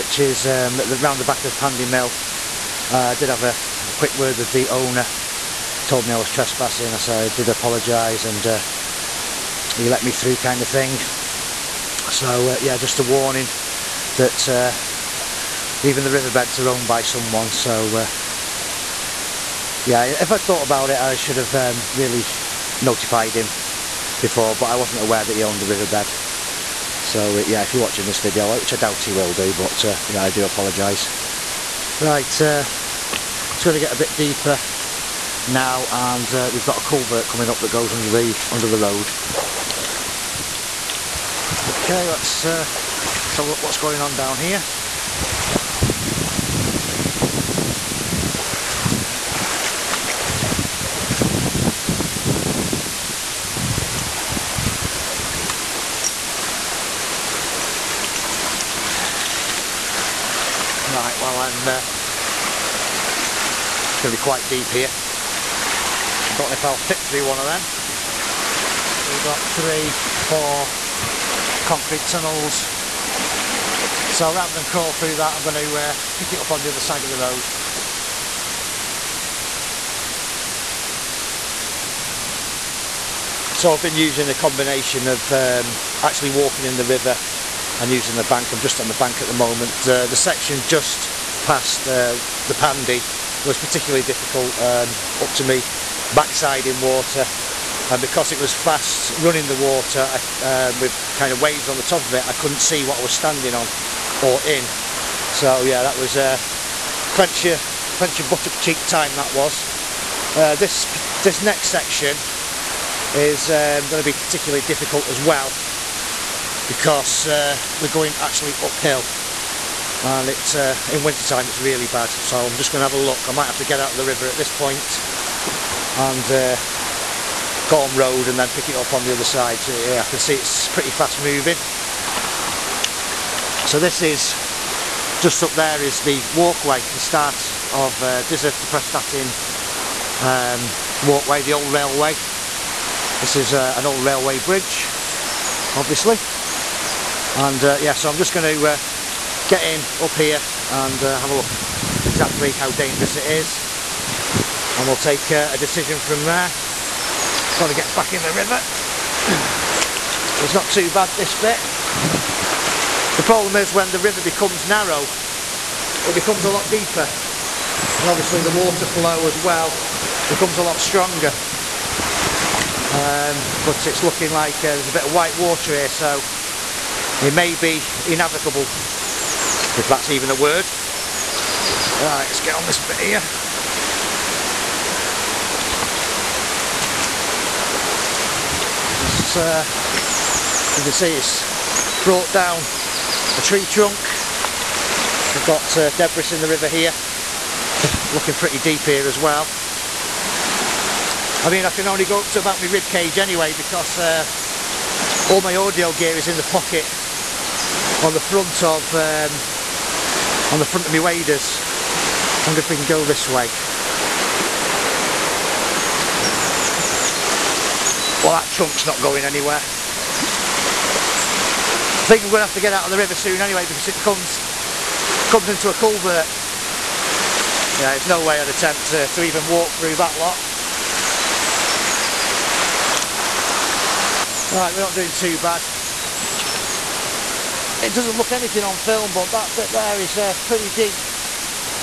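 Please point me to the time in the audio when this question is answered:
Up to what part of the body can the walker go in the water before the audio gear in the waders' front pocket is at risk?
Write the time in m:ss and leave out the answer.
3:22.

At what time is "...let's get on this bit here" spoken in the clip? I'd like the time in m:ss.
3:02.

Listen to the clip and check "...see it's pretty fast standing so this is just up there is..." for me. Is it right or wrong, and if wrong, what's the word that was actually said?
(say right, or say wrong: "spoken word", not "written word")
wrong: "moving", not "standing".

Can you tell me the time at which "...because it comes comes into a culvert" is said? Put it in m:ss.
3:43.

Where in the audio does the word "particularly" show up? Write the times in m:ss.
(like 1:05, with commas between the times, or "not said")
1:33, 1:54.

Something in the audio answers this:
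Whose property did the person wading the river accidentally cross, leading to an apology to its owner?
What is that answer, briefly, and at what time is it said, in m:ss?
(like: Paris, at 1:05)
Pandy Mill, at 0:01.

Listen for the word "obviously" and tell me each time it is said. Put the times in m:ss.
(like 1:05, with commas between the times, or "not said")
2:25, 2:48.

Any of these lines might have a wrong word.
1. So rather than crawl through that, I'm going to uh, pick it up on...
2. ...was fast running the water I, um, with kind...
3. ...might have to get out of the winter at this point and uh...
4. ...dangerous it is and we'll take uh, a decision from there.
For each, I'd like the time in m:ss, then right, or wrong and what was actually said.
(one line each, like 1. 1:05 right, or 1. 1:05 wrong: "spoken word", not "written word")
1. 1:14 right
2. 1:38 right
3. 2:03 wrong: "river", not "winter"
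4. 2:32 right.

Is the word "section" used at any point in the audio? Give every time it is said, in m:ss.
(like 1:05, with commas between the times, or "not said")
1:30, 1:51.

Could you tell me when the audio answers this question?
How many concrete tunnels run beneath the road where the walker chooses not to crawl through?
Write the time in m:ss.
1:10.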